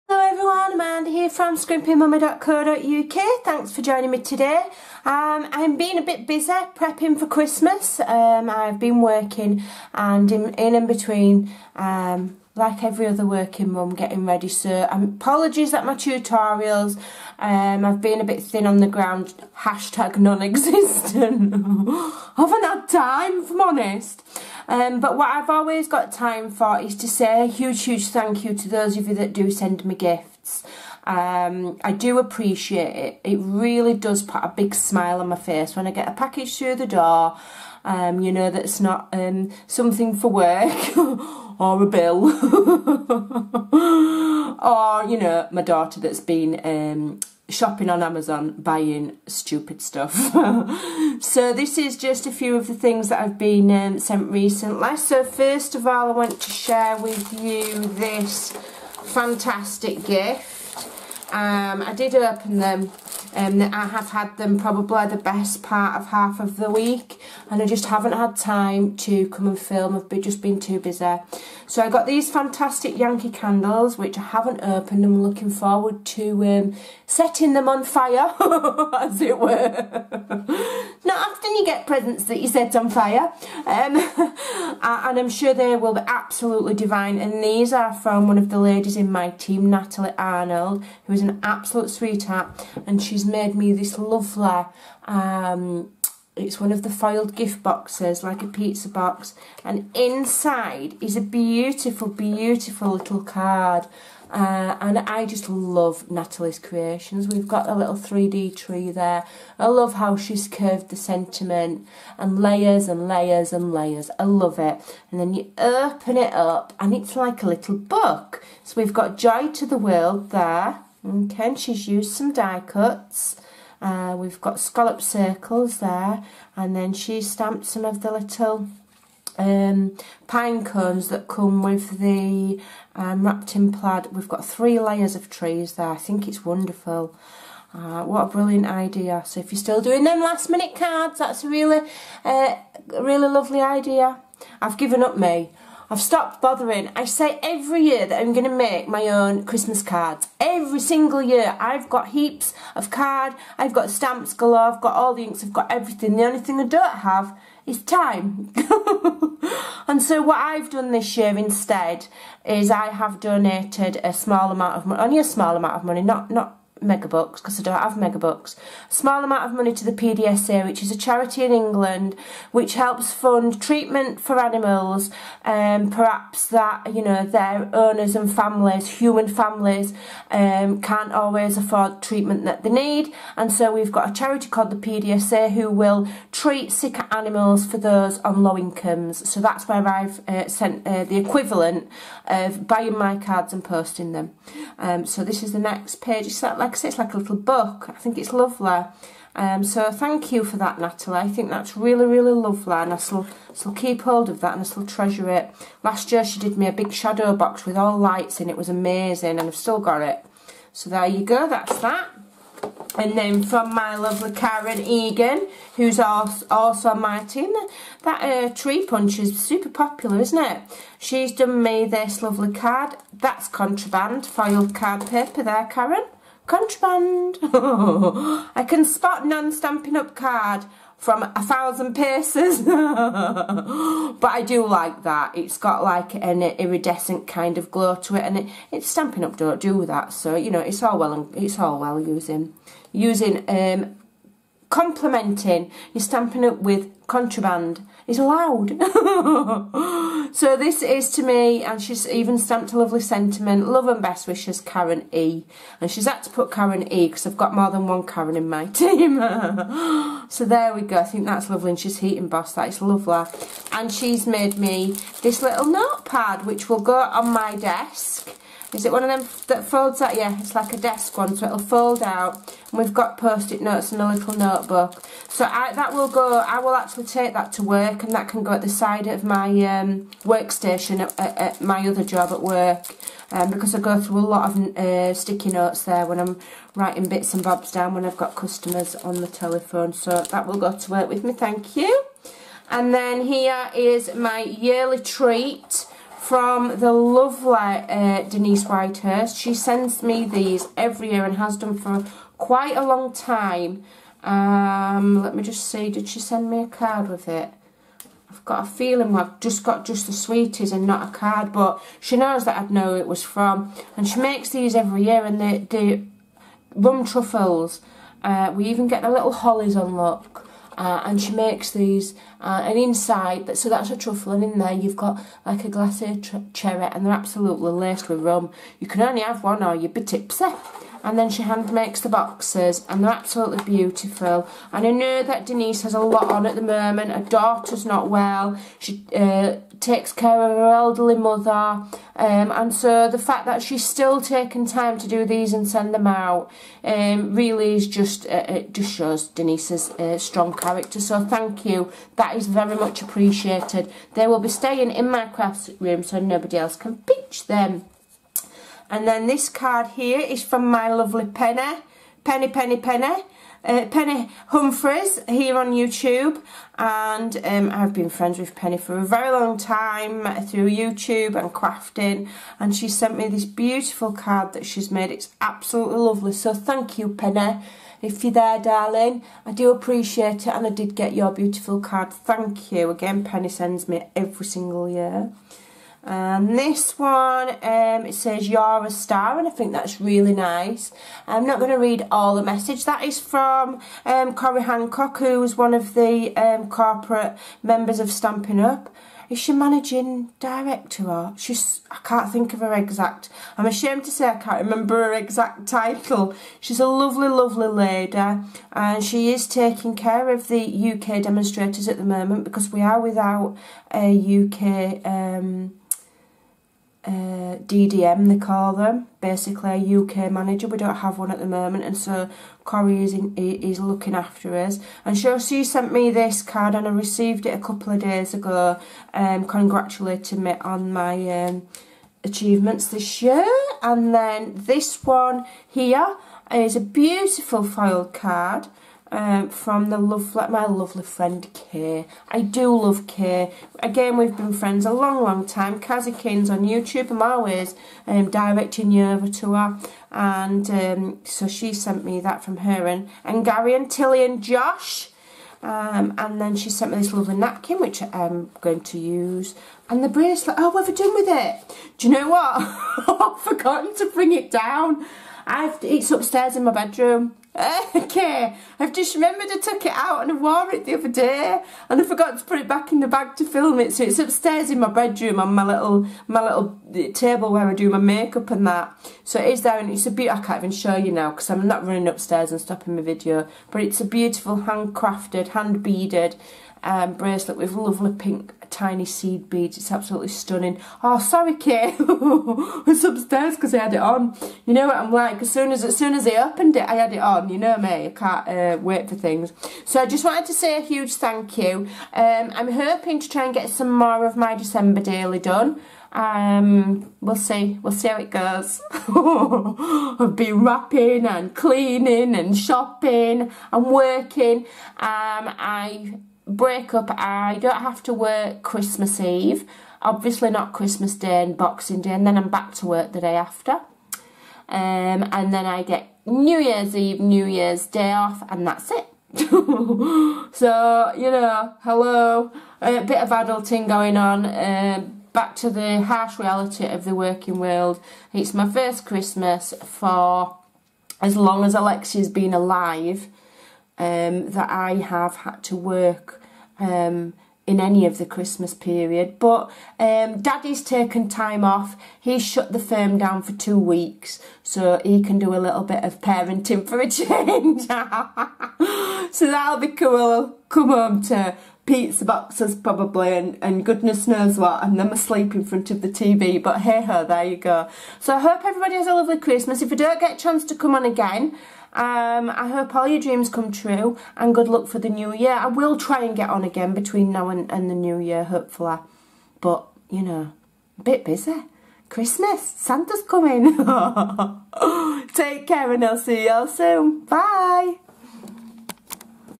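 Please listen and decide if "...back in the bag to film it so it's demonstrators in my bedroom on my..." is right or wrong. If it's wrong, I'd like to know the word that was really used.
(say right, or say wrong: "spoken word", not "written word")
wrong: "upstairs", not "demonstrators".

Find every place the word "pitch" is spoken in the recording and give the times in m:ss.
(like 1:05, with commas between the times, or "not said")
5:56.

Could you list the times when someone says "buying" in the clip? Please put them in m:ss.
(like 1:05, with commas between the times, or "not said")
0:48, 3:12.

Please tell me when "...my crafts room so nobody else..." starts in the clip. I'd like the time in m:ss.
5:55.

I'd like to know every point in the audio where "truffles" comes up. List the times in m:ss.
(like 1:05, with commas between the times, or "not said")
5:17, 5:23.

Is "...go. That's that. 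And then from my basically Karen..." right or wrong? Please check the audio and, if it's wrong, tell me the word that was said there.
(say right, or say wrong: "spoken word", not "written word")
wrong: "lovely", not "basically".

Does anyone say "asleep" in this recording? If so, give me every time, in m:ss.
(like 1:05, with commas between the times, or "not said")
9:25.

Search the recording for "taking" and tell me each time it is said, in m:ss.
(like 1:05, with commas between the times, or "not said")
5:44, 6:49.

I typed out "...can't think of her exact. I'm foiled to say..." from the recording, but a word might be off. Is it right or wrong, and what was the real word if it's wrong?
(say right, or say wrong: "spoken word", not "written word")
wrong: "ashamed", not "foiled".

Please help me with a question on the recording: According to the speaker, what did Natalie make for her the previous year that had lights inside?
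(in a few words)
shadow box.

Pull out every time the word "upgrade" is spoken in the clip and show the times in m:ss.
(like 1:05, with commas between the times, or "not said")
not said.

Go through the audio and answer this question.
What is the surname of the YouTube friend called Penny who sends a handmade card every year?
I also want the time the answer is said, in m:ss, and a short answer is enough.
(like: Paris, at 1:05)
Humphreys, at 6:04.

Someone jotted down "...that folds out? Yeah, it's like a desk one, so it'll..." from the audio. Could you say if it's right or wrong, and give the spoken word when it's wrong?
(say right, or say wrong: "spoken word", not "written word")
right.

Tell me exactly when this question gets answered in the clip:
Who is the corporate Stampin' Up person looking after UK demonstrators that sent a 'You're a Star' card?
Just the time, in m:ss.
6:34.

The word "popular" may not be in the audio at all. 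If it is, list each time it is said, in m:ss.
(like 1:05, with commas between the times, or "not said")
3:39.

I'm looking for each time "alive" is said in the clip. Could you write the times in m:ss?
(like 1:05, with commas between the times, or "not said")
9:02.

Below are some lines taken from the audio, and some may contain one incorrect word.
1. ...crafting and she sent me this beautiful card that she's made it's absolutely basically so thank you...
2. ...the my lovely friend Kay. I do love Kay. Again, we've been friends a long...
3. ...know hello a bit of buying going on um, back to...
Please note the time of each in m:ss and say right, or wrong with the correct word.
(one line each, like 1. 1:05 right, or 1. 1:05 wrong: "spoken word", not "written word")
1. 6:11 wrong: "lovely", not "basically"
2. 7:19 right
3. 8:51 wrong: "adulting", not "buying".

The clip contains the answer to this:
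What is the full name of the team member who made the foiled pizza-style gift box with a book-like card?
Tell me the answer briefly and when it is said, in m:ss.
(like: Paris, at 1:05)
Natalie Arnold, at 1:29.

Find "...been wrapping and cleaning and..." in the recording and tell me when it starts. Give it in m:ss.
8:30.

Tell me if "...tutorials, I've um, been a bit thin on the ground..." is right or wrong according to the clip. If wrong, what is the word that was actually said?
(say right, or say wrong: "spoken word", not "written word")
right.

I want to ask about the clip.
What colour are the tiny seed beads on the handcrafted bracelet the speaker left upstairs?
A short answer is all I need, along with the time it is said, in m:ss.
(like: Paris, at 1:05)
pink, at 8:08.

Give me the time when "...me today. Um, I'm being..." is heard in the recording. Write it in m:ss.
0:04.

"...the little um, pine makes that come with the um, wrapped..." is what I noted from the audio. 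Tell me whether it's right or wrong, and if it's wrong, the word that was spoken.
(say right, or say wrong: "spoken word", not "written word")
wrong: "cones", not "makes".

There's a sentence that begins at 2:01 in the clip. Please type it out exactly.
Okay, and she's used some die cuts.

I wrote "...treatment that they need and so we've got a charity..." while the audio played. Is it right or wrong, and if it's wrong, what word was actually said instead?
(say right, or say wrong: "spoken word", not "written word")
right.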